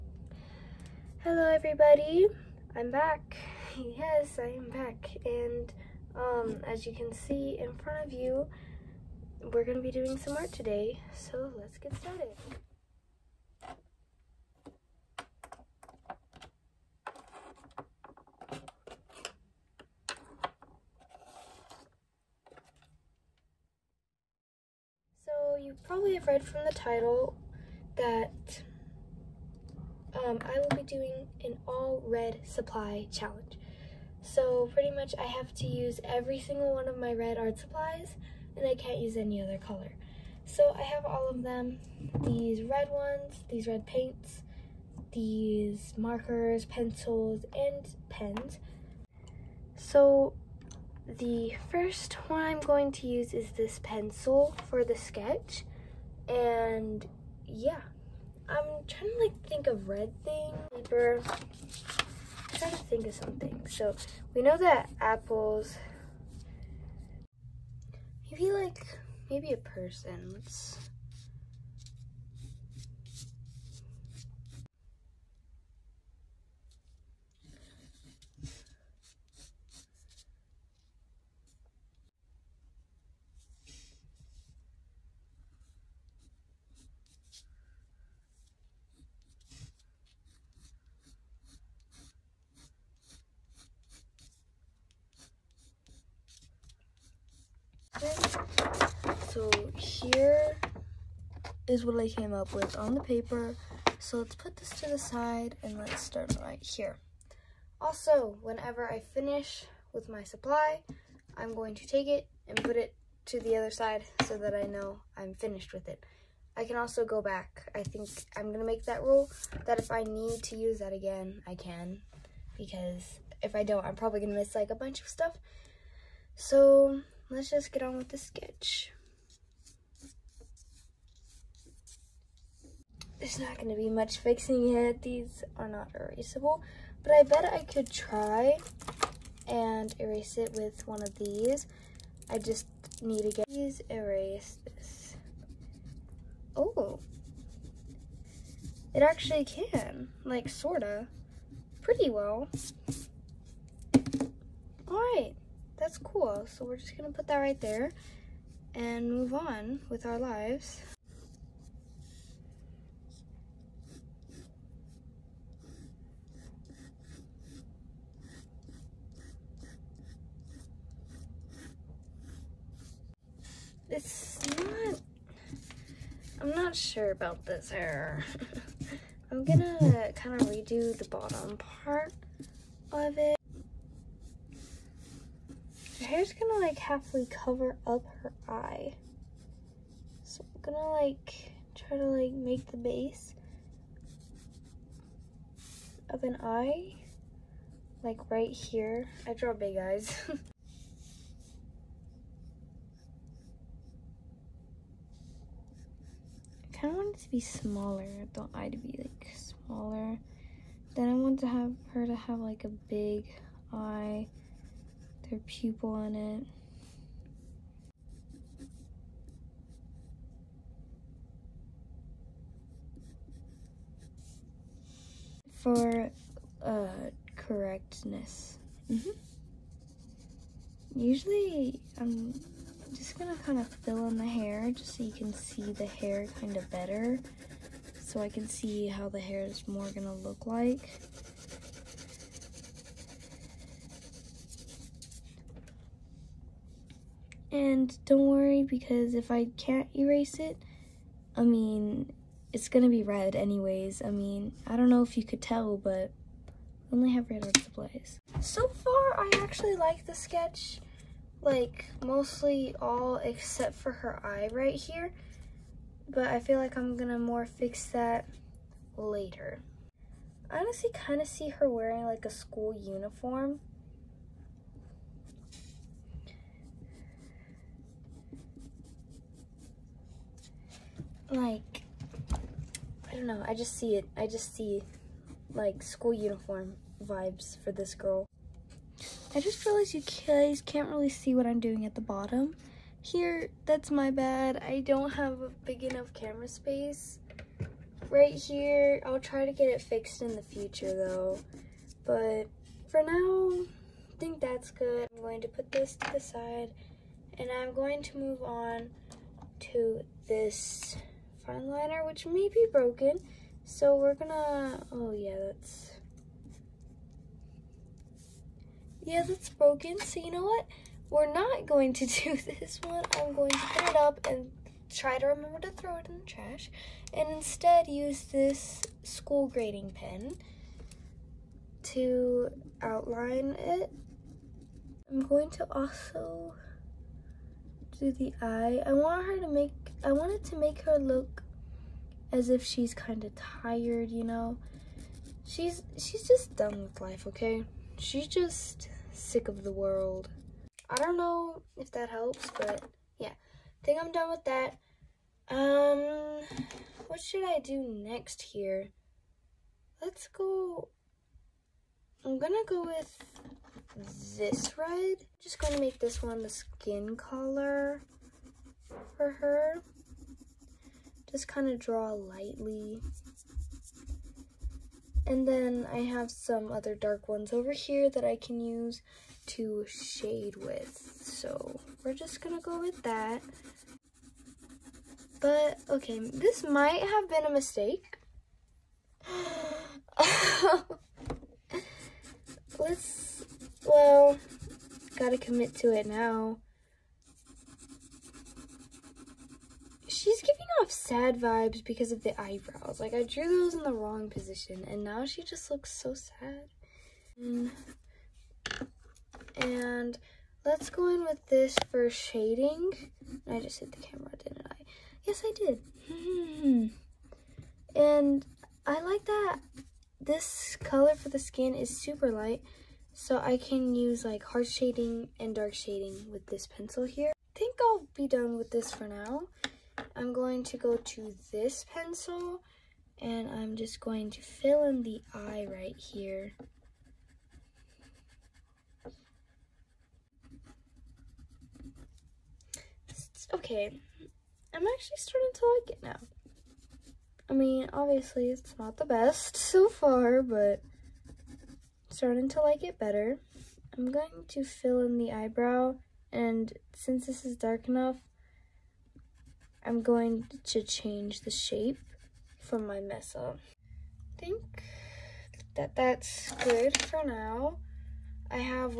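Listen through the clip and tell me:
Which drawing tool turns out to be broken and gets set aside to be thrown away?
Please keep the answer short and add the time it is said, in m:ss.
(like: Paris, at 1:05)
Fine liner, at 5:11.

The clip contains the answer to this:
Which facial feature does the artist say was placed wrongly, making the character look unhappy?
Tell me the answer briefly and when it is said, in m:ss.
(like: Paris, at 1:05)
Eyebrows, at 6:42.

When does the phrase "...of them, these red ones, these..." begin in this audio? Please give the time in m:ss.
0:41.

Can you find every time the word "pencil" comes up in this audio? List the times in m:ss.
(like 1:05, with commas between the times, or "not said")
0:46, 0:53, 7:06, 7:11.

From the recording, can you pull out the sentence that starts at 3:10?
So I'm gonna like try to like make the base of an eye like right here.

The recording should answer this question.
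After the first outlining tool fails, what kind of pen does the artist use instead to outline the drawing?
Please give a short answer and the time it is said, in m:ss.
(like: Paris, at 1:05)
School grading pen, at 5:29.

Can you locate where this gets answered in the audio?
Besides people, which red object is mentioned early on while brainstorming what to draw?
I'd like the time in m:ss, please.
1:04.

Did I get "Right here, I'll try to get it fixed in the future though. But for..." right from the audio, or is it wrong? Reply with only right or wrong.
right.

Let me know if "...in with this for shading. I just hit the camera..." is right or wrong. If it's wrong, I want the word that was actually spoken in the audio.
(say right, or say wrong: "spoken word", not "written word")
right.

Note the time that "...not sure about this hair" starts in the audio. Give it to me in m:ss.
2:56.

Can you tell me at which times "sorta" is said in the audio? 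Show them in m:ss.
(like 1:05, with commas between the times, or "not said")
2:30.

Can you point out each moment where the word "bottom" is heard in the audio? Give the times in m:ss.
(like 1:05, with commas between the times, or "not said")
3:01, 4:51.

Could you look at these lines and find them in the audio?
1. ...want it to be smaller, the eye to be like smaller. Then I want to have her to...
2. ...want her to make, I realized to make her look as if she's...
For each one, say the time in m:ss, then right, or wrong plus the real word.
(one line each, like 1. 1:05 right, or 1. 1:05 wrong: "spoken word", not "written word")
1. 3:27 right
2. 5:38 wrong: "wanted", not "realized".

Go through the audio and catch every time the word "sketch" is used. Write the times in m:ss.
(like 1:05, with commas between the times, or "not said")
0:54, 2:08, 4:20.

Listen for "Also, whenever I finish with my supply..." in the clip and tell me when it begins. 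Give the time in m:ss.
1:47.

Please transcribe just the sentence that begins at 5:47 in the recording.
She's just sick of the world.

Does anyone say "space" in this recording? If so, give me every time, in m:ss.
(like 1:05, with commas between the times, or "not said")
4:56.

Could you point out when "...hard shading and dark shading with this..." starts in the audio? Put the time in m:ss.
7:04.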